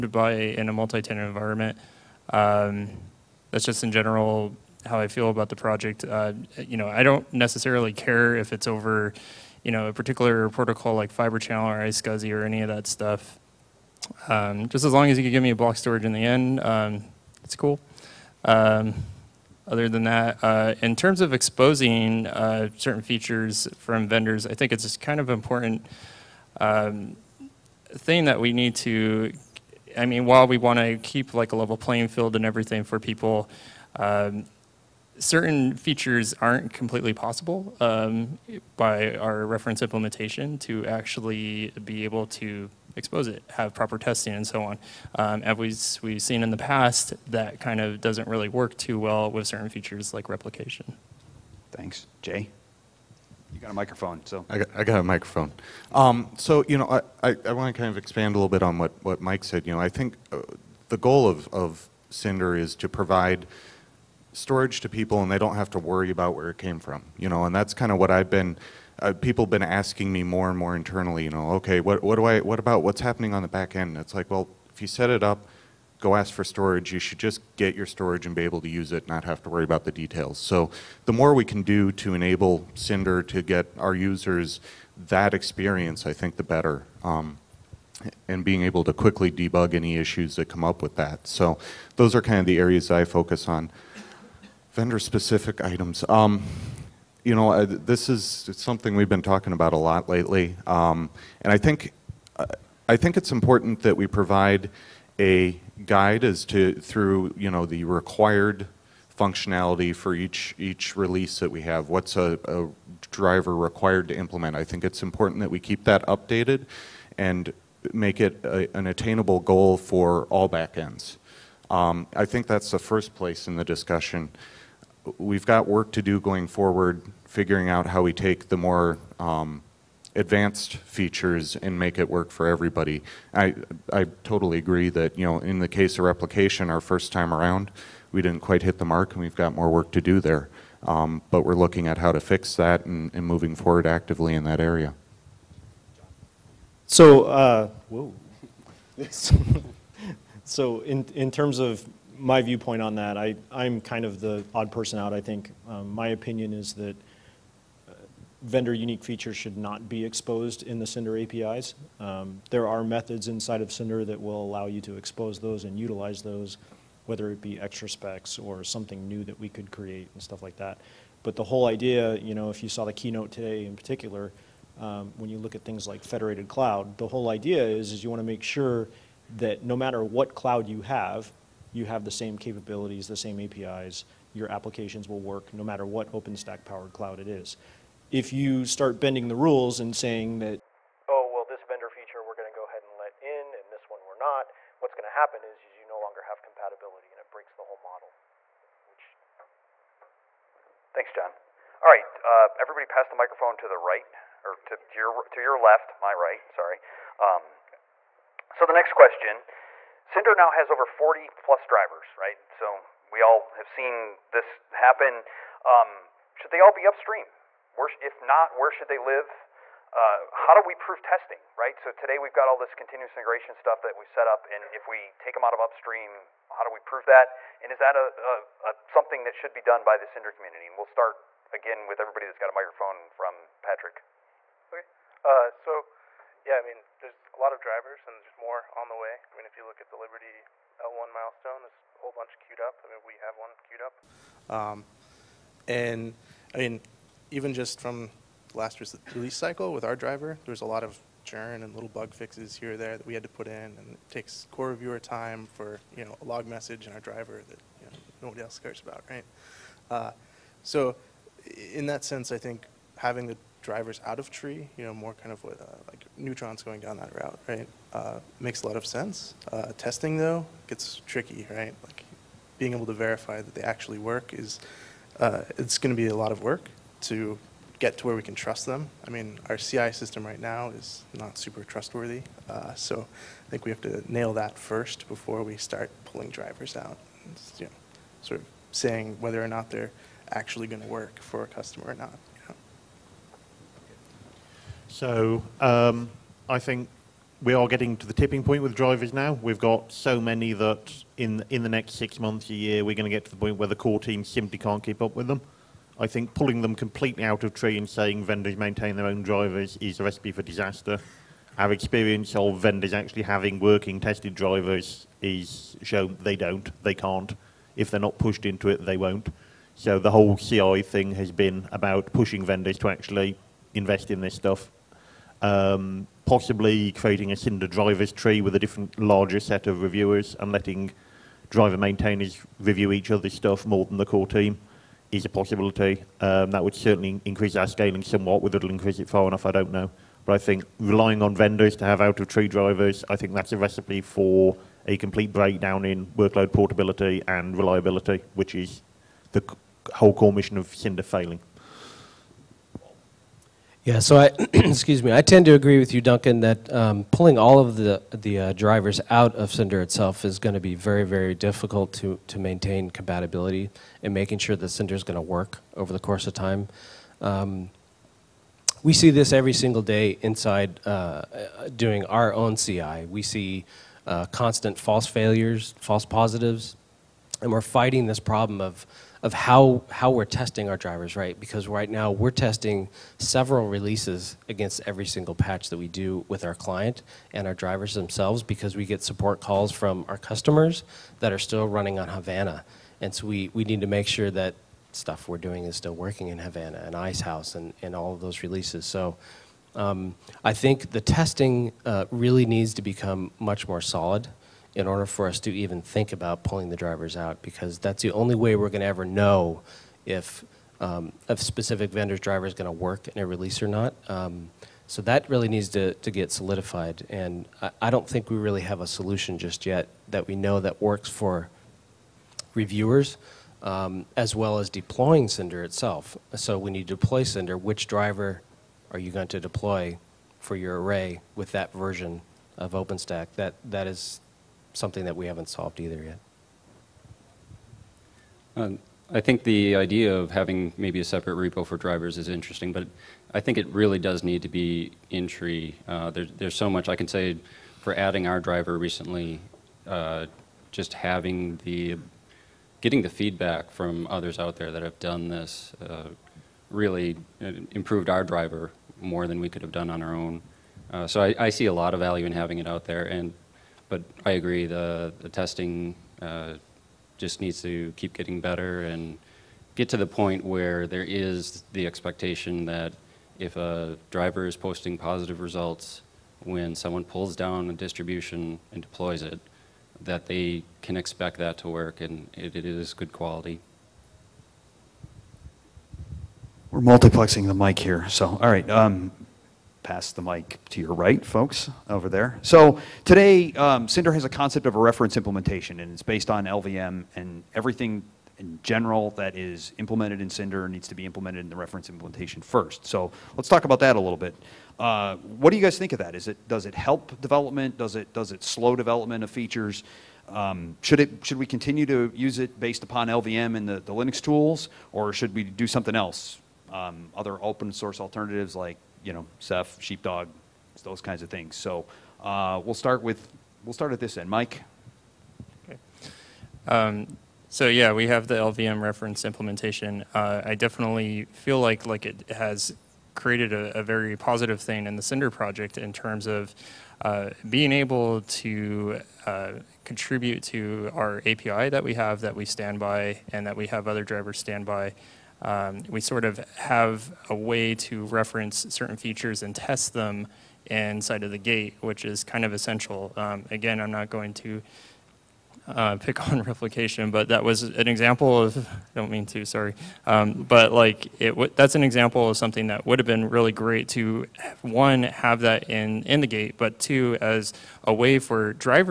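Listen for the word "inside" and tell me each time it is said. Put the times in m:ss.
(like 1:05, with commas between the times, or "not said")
2:43, 6:10, 9:10.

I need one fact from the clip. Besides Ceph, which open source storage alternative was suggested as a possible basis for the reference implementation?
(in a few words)
Sheepdog.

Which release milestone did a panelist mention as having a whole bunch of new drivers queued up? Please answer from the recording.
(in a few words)
Liberty L1.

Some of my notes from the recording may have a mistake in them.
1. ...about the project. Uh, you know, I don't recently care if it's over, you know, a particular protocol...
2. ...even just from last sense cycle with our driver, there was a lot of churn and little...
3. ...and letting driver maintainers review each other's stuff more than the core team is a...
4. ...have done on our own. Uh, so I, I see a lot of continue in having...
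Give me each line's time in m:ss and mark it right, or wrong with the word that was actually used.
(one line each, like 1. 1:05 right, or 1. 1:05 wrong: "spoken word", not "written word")
1. 0:05 wrong: "necessarily", not "recently"
2. 4:07 wrong: "release", not "sense"
3. 5:30 right
4. 7:39 wrong: "value", not "continue".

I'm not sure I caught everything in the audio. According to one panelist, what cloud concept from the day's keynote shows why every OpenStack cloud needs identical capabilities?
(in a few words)
federated cloud.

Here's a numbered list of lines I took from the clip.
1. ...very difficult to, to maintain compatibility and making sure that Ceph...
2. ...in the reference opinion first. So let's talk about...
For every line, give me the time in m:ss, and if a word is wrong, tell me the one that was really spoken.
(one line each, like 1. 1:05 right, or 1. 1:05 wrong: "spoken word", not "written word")
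1. 6:01 wrong: "Cinder", not "Ceph"
2. 8:21 wrong: "implementation", not "opinion".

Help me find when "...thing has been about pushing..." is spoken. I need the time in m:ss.
5:20.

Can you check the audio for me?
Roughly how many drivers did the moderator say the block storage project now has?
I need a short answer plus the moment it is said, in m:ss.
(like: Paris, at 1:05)
40, at 3:30.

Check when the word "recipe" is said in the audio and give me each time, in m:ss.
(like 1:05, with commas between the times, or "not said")
5:10, 5:43.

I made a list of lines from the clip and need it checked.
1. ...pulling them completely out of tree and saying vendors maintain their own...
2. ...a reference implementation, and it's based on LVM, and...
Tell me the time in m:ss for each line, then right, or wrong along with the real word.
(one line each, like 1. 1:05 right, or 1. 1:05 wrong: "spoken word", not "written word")
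1. 5:06 right
2. 8:14 right.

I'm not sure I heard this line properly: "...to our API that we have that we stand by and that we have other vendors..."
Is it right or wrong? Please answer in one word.
wrong.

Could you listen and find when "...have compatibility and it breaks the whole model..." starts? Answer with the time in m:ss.
3:16.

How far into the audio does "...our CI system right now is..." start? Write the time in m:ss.
4:39.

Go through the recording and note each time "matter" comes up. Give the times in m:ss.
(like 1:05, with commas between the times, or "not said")
2:59, 3:05.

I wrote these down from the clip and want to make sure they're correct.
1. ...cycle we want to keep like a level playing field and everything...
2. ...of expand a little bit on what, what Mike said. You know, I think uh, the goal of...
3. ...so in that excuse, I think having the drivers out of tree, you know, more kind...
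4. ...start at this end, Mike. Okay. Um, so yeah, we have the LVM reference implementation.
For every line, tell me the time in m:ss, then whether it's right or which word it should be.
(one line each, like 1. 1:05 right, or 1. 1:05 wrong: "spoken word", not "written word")
1. 0:30 wrong: "while", not "cycle"
2. 0:57 right
3. 4:20 wrong: "sense", not "excuse"
4. 8:43 right.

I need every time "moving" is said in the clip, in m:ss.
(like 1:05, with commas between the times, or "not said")
2:23.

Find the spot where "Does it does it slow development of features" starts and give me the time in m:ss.
8:27.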